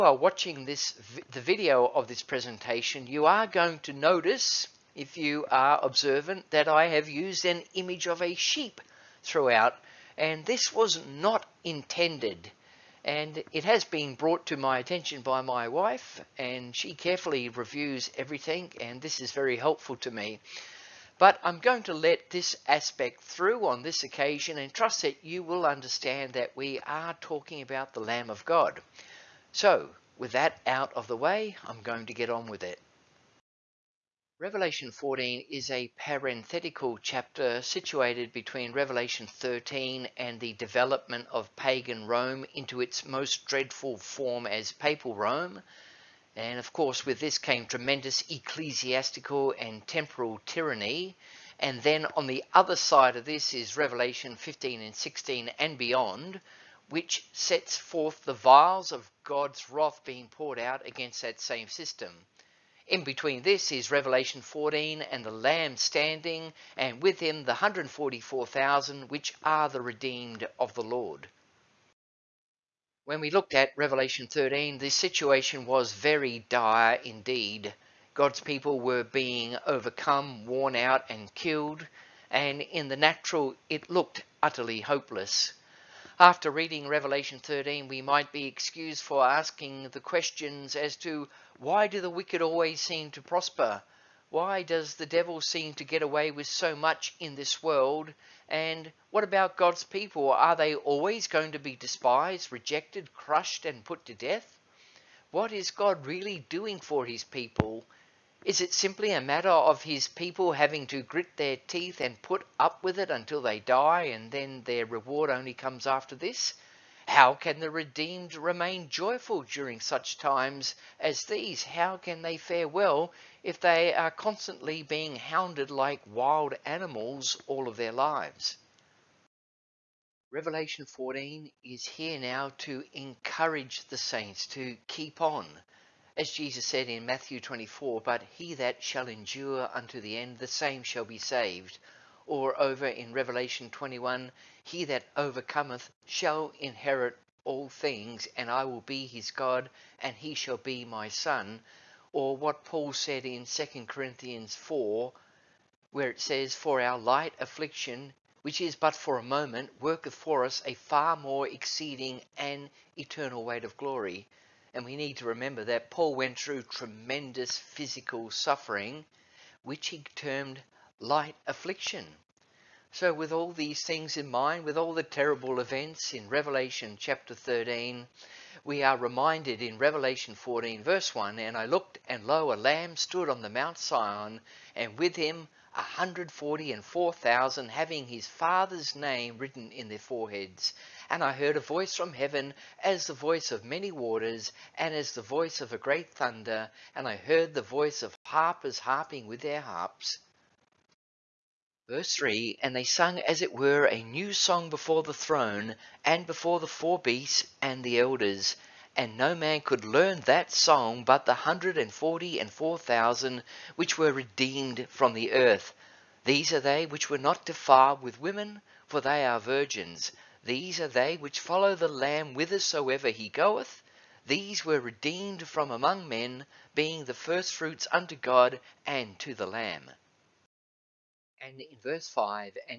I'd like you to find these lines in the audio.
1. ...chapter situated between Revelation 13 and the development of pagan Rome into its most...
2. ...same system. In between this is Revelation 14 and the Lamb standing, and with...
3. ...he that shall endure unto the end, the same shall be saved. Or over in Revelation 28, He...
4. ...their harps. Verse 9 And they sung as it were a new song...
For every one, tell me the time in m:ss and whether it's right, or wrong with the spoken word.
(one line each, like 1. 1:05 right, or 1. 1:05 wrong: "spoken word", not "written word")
1. 0:37 right
2. 1:01 right
3. 2:18 wrong: "21", not "28"
4. 3:19 wrong: "3", not "9".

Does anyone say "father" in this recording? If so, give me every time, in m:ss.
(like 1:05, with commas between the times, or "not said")
3:08.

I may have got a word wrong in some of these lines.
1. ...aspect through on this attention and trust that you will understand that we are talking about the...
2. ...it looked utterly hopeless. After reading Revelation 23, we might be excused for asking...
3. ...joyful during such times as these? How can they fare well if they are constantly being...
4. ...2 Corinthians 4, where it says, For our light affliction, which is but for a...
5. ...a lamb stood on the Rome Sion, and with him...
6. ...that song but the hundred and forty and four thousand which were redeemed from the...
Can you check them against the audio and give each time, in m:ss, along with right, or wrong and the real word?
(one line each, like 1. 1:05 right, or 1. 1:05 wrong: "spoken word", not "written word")
1. 0:22 wrong: "occasion", not "attention"
2. 1:23 wrong: "13", not "23"
3. 1:58 right
4. 2:33 right
5. 3:02 wrong: "Mount", not "Rome"
6. 3:30 right.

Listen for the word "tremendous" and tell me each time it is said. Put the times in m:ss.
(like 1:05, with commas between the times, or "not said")
0:47, 2:46.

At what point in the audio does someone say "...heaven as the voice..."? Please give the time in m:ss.
3:12.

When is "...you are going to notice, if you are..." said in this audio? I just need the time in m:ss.
0:03.